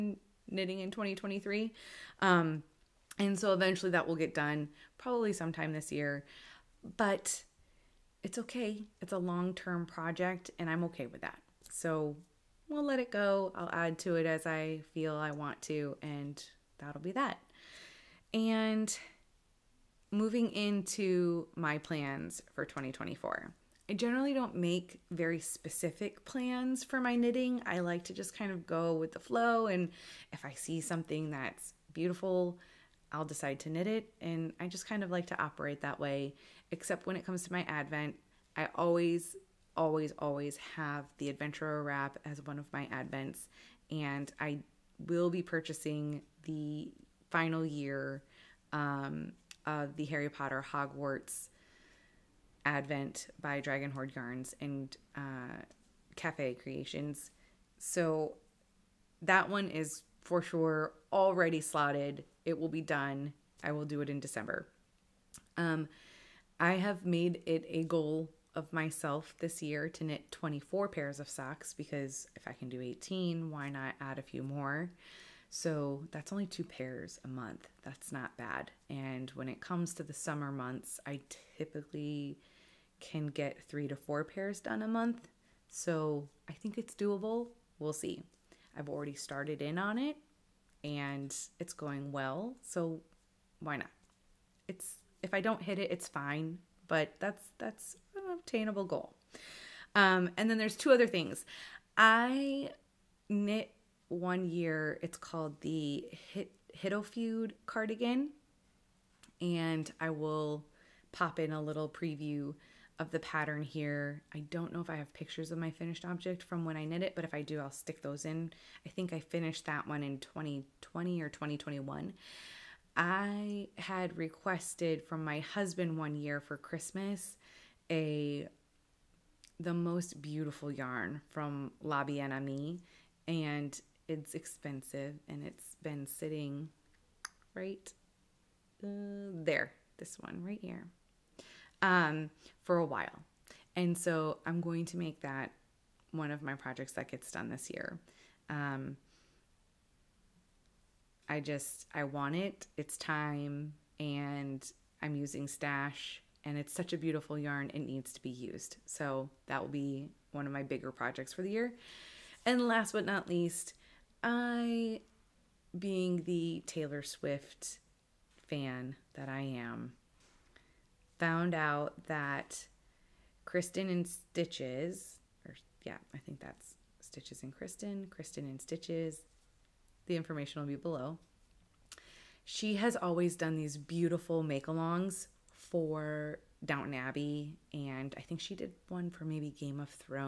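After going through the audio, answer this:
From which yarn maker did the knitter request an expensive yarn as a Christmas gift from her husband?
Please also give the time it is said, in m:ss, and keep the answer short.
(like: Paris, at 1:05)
La Bien Aimée, at 2:11.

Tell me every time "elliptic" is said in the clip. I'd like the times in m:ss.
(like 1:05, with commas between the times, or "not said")
not said.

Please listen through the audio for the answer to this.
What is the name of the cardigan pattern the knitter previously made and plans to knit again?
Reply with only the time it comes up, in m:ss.
1:46.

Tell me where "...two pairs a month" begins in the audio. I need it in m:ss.
1:16.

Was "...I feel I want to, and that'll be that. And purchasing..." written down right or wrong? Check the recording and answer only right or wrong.
wrong.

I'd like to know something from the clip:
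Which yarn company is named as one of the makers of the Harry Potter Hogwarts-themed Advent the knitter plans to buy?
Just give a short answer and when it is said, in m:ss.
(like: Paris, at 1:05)
Dragon Hoard Yarns, at 0:53.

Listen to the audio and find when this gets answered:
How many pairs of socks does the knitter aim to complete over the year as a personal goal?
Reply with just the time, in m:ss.
1:10.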